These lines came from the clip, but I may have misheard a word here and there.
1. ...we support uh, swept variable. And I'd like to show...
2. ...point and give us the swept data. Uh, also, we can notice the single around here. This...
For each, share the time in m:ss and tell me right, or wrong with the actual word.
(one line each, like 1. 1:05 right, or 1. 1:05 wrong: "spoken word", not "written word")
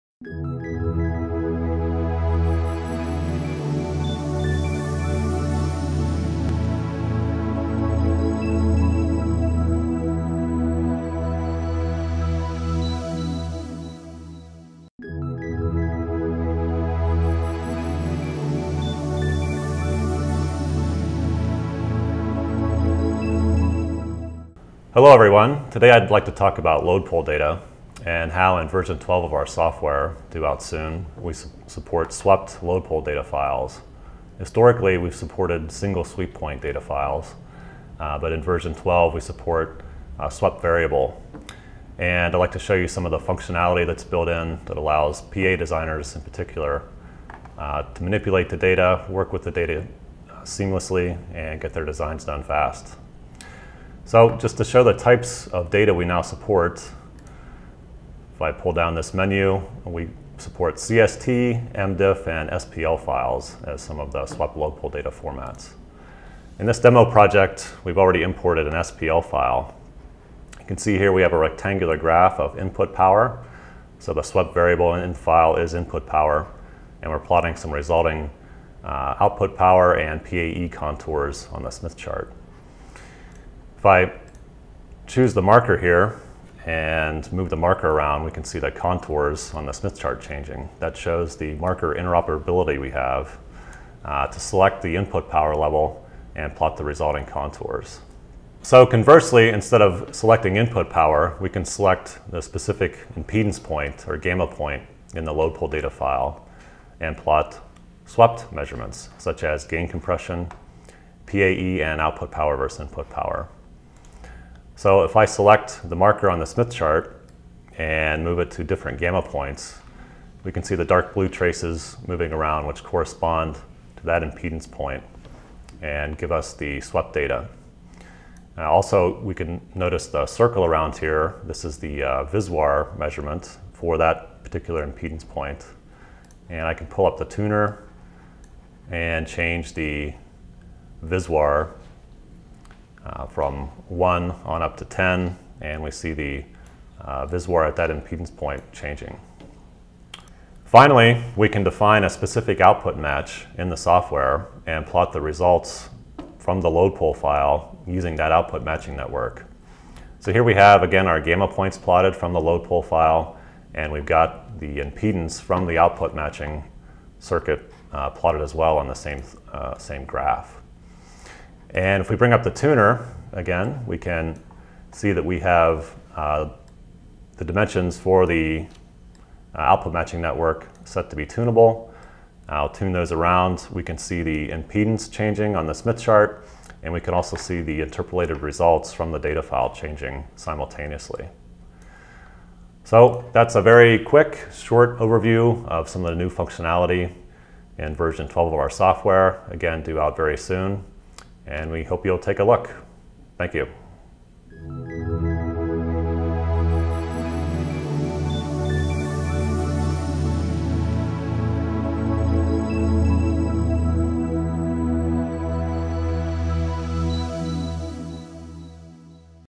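1. 0:39 right
2. 2:04 wrong: "circle", not "single".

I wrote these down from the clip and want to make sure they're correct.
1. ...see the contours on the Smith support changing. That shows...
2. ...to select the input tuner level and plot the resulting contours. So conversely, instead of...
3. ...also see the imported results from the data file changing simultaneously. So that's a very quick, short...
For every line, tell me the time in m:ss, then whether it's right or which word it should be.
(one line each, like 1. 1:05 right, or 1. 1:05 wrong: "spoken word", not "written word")
1. 1:28 wrong: "chart", not "support"
2. 1:34 wrong: "power", not "tuner"
3. 3:07 wrong: "interpolated", not "imported".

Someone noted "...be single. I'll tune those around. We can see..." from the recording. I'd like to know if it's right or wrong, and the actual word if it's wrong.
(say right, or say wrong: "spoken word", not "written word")
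wrong: "tunable", not "single".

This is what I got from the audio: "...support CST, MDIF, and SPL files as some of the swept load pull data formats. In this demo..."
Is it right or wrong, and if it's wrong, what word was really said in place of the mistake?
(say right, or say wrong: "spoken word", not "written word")
right.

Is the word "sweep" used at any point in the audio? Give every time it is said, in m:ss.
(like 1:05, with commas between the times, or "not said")
0:36.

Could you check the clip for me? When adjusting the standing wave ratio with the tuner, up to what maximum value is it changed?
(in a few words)
10.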